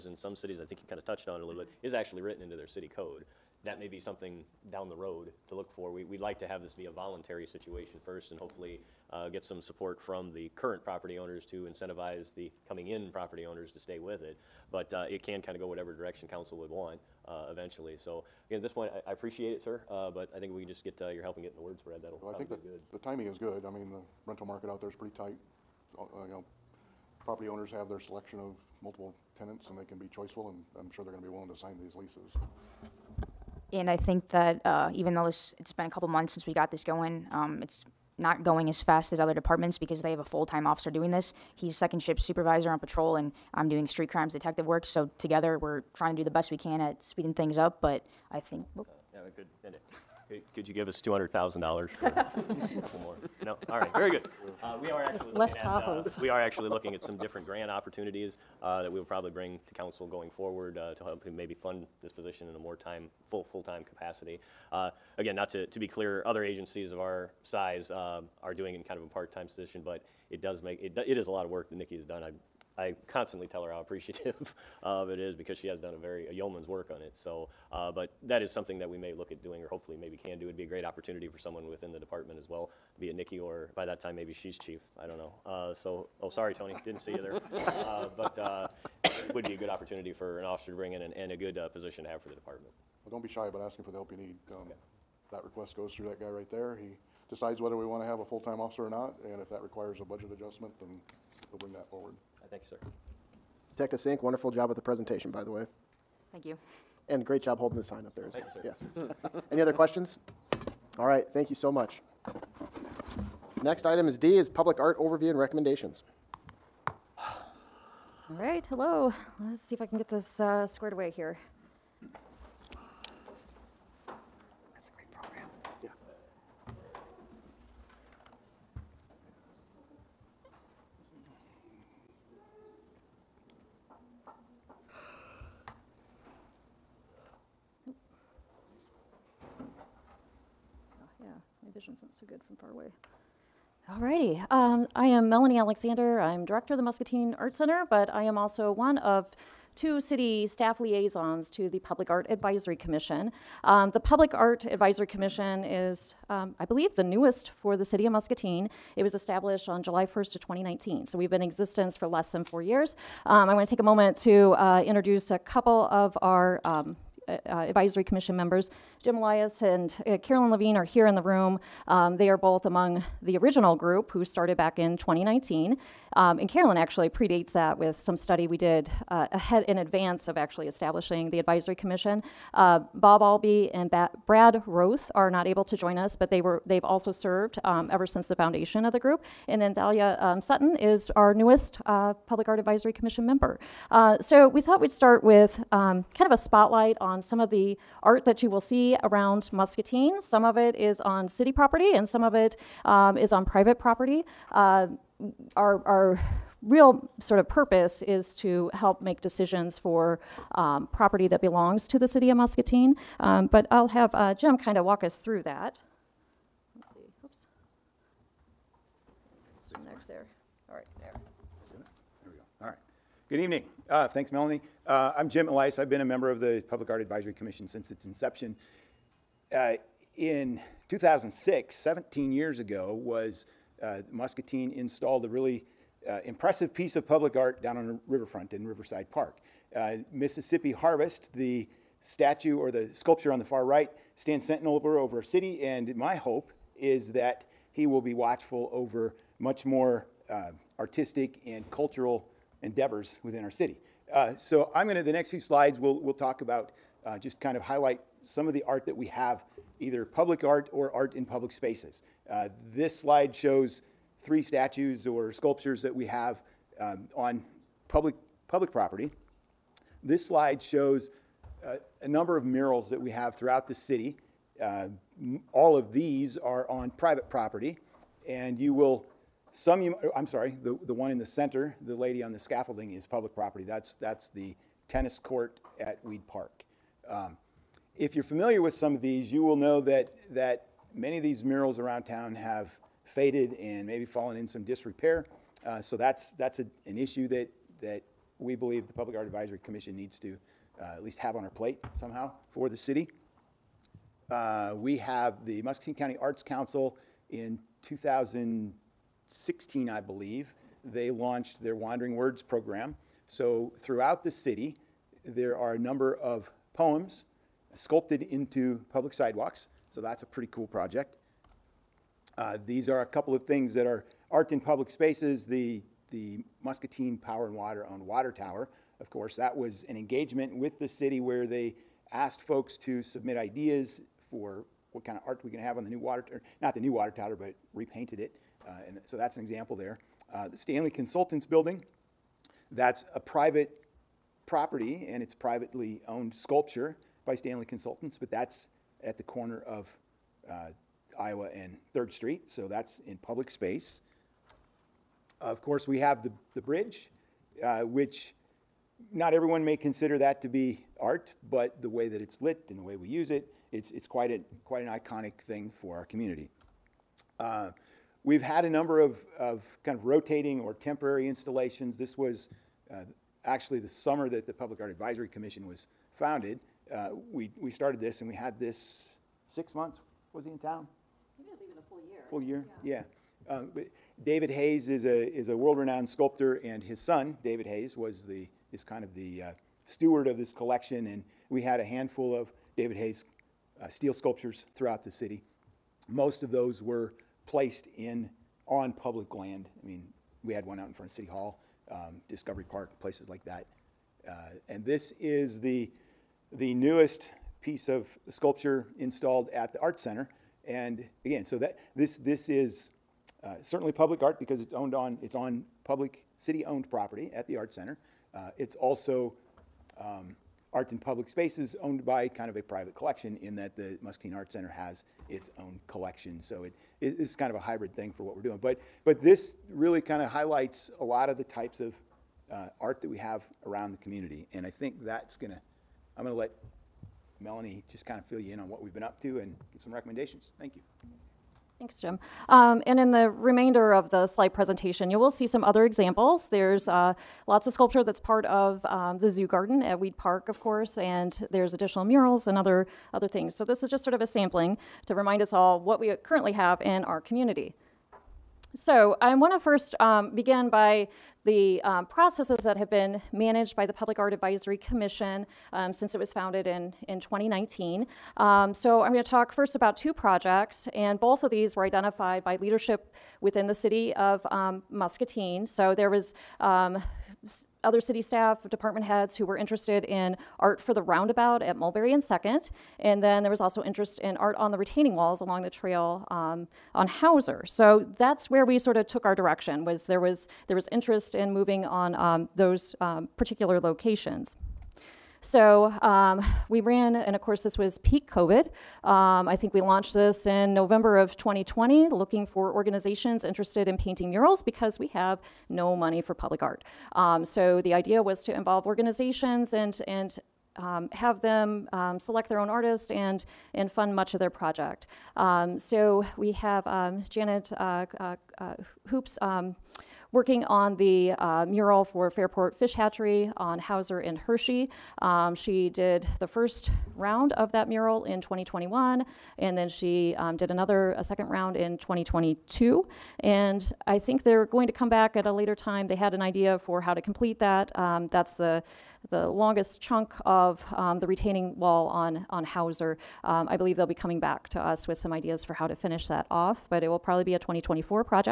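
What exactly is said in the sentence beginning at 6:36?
Most of those were placed in on public land.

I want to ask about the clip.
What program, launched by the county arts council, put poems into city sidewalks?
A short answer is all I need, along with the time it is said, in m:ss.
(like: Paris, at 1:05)
Wandering Words, at 5:11.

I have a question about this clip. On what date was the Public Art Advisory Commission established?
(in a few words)
July 1, 2019.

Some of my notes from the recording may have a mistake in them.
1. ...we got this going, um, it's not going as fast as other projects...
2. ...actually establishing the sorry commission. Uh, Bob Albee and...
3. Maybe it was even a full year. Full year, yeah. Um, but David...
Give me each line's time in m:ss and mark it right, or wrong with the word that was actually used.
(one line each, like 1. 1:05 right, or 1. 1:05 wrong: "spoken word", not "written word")
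1. 0:36 wrong: "departments", not "projects"
2. 3:00 wrong: "advisory", not "sorry"
3. 6:21 right.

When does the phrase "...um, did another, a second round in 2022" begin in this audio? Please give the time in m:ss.
8:50.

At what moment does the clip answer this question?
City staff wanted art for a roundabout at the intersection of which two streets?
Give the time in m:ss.
8:01.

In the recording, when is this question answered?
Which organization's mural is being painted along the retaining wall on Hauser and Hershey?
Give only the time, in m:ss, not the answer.
8:42.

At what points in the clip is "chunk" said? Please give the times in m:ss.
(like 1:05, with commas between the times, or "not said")
8:59.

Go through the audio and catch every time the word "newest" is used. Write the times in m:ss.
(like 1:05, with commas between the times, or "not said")
2:37, 3:11, 6:46.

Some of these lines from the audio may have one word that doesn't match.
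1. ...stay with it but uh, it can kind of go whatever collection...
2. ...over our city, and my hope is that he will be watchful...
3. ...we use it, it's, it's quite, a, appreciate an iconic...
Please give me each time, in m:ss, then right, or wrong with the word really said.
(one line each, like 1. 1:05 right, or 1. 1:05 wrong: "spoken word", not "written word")
1. 0:13 wrong: "direction", not "collection"
2. 4:04 right
3. 6:02 wrong: "quite", not "appreciate".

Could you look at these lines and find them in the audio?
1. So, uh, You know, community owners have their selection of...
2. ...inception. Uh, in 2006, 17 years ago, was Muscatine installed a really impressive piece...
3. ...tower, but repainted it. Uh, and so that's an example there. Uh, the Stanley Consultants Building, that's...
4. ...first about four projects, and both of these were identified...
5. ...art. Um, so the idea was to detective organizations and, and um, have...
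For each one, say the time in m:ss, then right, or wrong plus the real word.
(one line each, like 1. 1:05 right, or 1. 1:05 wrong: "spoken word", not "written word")
1. 0:25 wrong: "property", not "community"
2. 3:48 right
3. 5:37 right
4. 7:49 wrong: "two", not "four"
5. 8:26 wrong: "involve", not "detective".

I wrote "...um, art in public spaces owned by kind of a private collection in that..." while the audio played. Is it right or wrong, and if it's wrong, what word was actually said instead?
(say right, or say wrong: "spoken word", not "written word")
right.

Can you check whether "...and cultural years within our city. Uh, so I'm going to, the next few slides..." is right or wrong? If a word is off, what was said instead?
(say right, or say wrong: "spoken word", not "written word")
wrong: "endeavors", not "years".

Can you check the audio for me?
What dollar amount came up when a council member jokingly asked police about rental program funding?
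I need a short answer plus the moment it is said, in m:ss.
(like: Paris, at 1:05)
$200,000, at 0:51.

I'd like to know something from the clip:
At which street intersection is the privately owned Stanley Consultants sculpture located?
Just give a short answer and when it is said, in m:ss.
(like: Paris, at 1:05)
Iowa and 3rd Street, at 5:51.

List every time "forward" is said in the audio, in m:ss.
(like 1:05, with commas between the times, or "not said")
1:00, 1:41.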